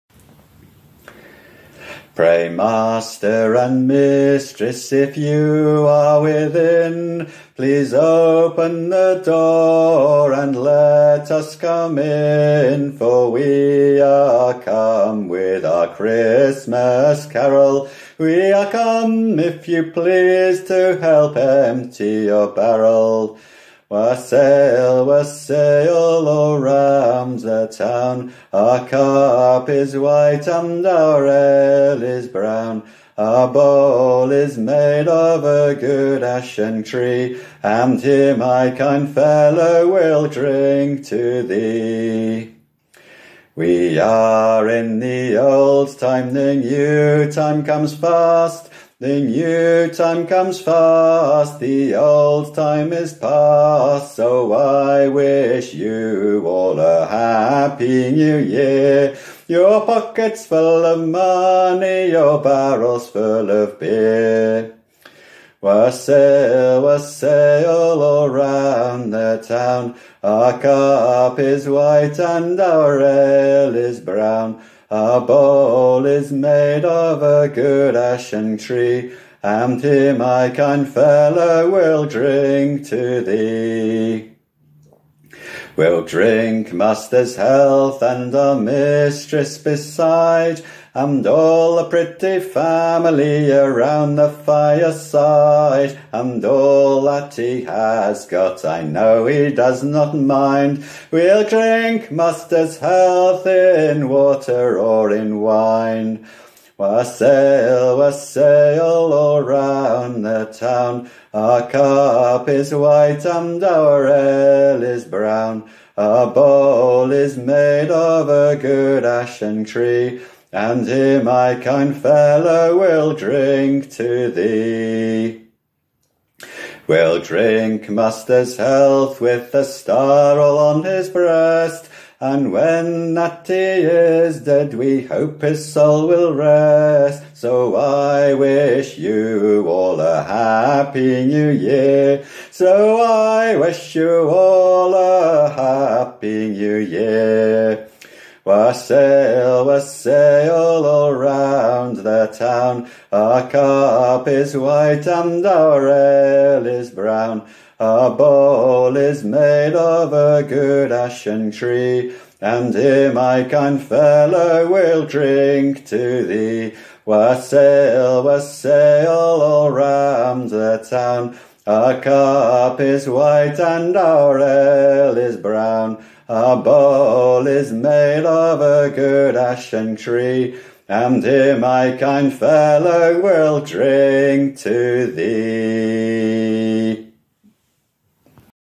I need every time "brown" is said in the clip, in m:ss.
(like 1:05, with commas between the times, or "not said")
0:32, 1:13, 1:55, 2:36, 2:55.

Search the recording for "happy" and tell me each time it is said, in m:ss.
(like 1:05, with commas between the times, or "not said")
0:57, 2:20, 2:25.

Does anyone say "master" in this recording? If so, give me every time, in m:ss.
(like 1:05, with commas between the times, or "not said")
0:02, 1:26, 1:42, 2:07.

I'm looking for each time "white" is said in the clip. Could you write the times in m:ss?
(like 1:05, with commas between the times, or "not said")
0:29, 1:11, 1:52, 2:34, 2:53.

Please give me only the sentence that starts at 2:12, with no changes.
And when Natty is dead, we hope his soul will rest.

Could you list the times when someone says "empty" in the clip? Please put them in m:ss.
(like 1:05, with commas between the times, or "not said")
0:21.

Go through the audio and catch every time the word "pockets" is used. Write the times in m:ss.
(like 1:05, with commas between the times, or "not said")
0:59.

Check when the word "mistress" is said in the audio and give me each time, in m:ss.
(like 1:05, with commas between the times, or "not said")
0:03, 1:28.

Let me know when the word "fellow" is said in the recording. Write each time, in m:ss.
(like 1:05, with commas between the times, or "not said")
0:39, 1:20, 2:01, 2:43, 3:02.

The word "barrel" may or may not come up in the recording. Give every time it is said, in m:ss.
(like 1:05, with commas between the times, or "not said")
0:22, 1:02.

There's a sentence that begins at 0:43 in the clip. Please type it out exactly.
We are in the old time, the new time comes fast.